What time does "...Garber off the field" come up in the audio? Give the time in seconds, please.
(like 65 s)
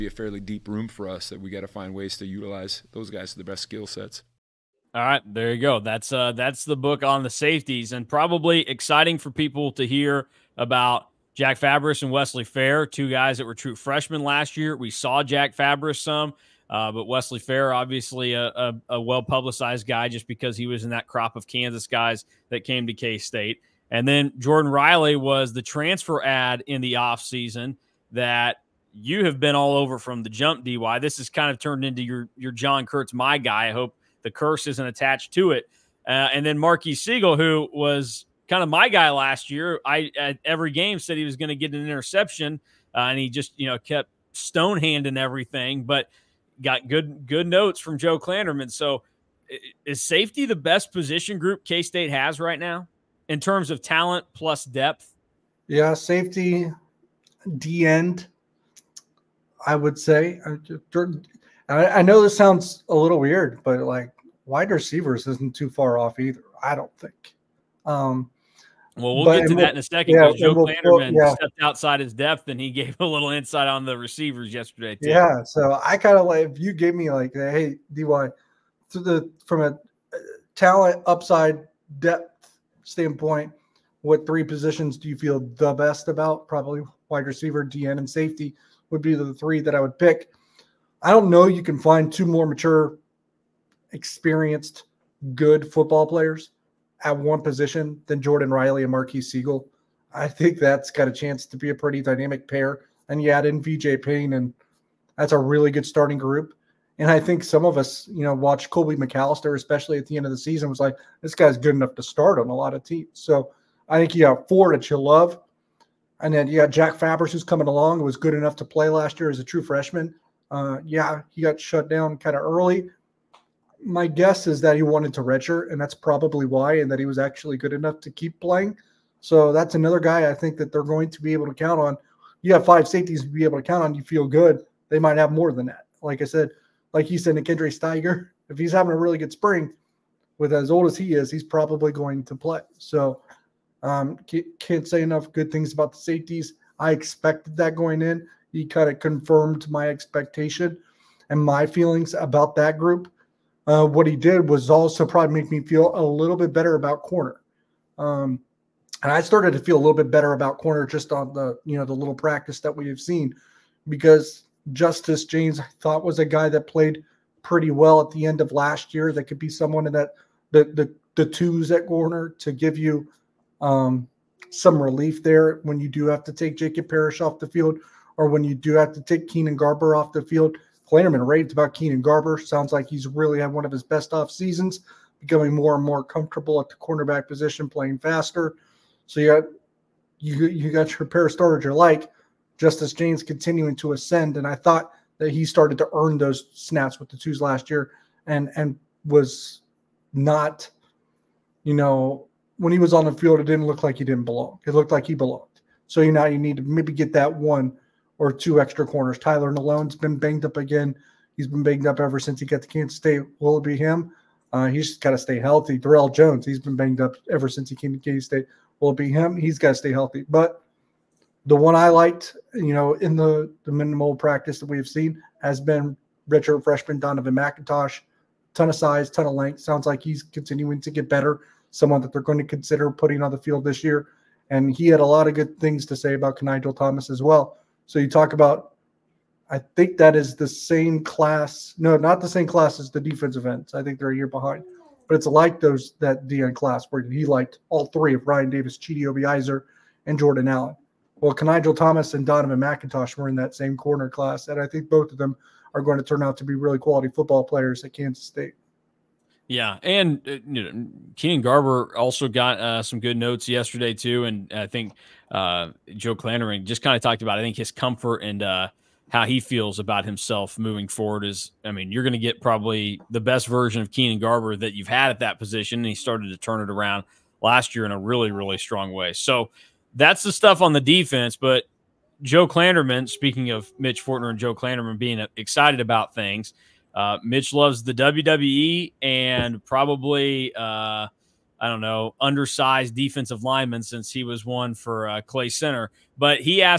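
179 s.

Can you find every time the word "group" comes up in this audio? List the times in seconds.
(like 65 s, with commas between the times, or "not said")
51 s, 106 s, 152 s.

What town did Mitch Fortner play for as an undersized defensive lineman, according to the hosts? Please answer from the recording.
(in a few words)
Clay Center.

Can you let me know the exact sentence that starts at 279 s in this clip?
So that's the stuff on the defense.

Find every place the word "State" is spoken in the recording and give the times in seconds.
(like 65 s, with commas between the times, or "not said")
23 s, 51 s, 212 s, 218 s, 258 s.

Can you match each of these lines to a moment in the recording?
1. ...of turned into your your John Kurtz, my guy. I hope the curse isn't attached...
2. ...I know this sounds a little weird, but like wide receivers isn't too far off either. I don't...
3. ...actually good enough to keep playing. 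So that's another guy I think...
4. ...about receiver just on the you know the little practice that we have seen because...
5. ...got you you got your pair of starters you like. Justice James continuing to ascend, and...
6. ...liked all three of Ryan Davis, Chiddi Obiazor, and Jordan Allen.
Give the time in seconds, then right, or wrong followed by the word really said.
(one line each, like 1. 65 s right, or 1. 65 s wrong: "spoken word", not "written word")
1. 31 s right
2. 61 s right
3. 127 s right
4. 160 s wrong: "corner", not "receiver"
5. 189 s right
6. 247 s right.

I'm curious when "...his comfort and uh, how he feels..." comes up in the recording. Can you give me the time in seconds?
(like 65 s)
267 s.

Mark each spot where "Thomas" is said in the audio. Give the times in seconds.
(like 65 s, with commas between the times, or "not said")
236 s, 251 s.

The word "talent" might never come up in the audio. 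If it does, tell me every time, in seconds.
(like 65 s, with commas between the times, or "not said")
53 s, 80 s.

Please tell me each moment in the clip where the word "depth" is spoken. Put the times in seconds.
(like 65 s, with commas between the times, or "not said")
54 s, 72 s, 81 s.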